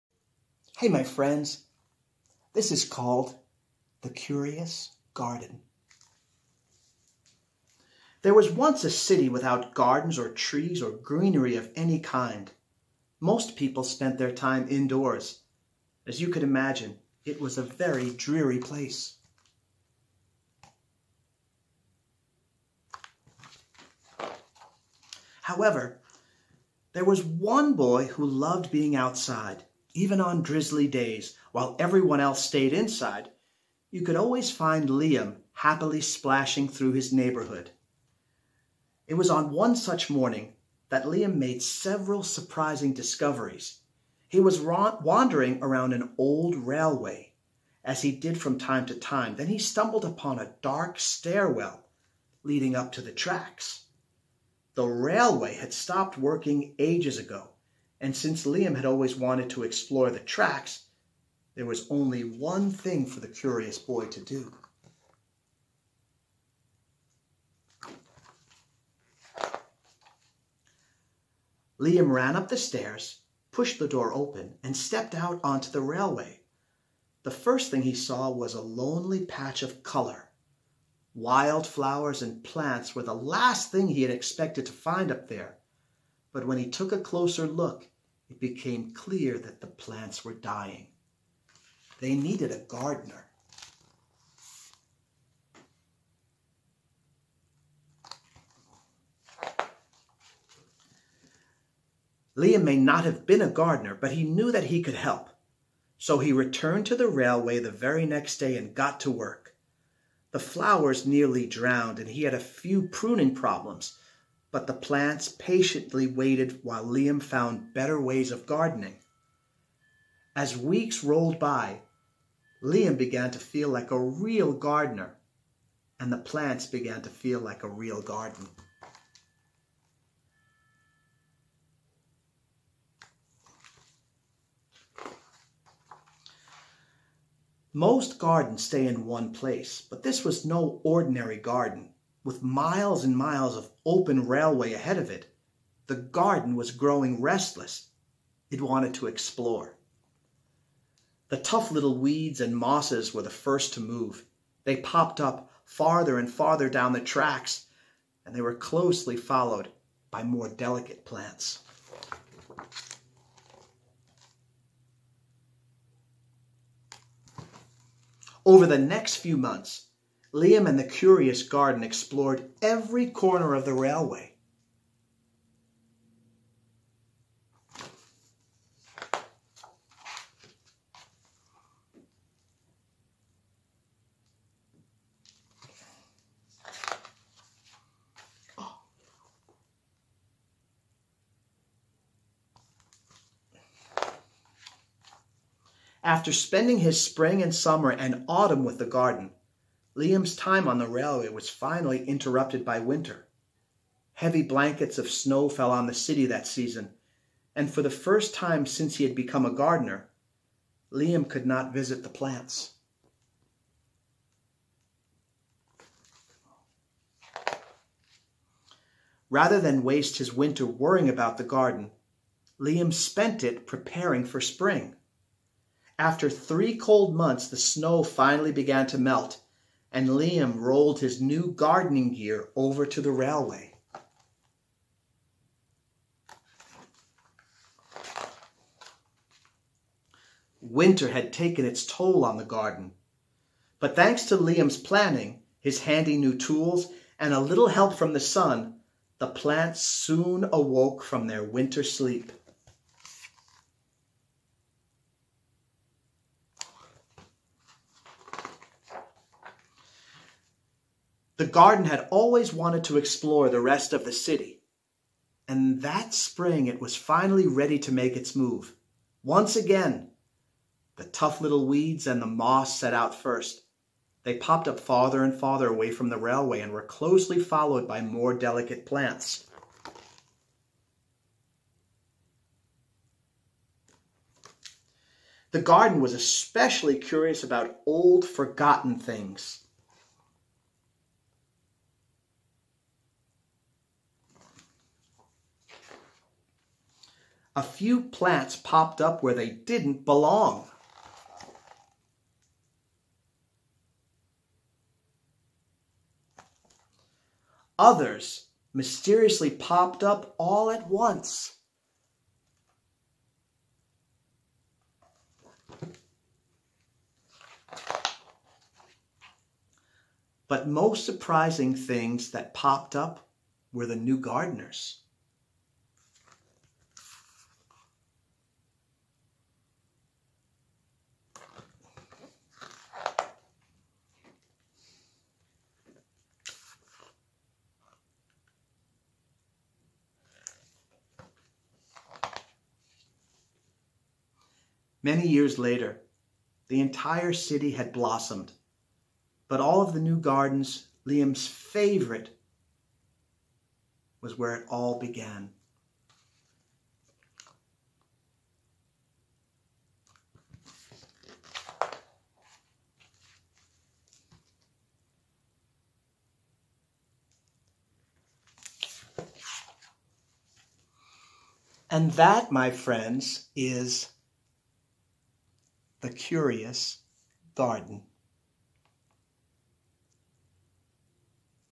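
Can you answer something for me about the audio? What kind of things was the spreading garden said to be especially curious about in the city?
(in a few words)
old, forgotten things.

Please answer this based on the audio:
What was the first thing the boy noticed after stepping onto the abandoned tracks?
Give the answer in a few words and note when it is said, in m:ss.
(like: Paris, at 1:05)
a lonely patch of color, at 1:18.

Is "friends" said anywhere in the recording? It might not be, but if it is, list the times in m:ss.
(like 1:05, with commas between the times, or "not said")
0:01, 6:12.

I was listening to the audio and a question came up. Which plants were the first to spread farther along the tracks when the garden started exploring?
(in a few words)
weeds and mosses.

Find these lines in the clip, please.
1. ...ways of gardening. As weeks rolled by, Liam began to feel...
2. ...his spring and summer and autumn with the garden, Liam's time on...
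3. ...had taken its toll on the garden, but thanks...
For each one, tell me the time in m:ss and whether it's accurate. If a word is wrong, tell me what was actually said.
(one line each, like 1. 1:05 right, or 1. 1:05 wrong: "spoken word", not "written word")
1. 1:57 right
2. 3:16 right
3. 4:01 right.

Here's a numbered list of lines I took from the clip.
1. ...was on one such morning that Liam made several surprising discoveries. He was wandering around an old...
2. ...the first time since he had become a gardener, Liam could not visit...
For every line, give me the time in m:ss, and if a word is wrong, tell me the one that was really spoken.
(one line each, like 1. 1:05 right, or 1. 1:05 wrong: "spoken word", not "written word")
1. 0:39 right
2. 3:27 right.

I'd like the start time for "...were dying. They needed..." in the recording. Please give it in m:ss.
1:30.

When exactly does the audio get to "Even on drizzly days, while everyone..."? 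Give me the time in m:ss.
0:29.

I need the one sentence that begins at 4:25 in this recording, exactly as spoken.
And that spring, it was finally ready to make its move.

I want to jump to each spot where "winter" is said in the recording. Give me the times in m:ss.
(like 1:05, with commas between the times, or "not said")
3:22, 3:40, 4:00, 4:11.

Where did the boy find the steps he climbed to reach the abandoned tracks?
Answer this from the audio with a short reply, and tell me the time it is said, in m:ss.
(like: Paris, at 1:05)
a dark stairwell, at 0:50.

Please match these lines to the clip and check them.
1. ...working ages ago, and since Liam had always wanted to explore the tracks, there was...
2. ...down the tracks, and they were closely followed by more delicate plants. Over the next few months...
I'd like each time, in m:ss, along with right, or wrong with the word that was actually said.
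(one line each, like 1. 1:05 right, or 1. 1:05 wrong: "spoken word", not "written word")
1. 0:56 right
2. 2:36 right.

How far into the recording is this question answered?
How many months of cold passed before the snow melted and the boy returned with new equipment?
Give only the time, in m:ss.
3:46.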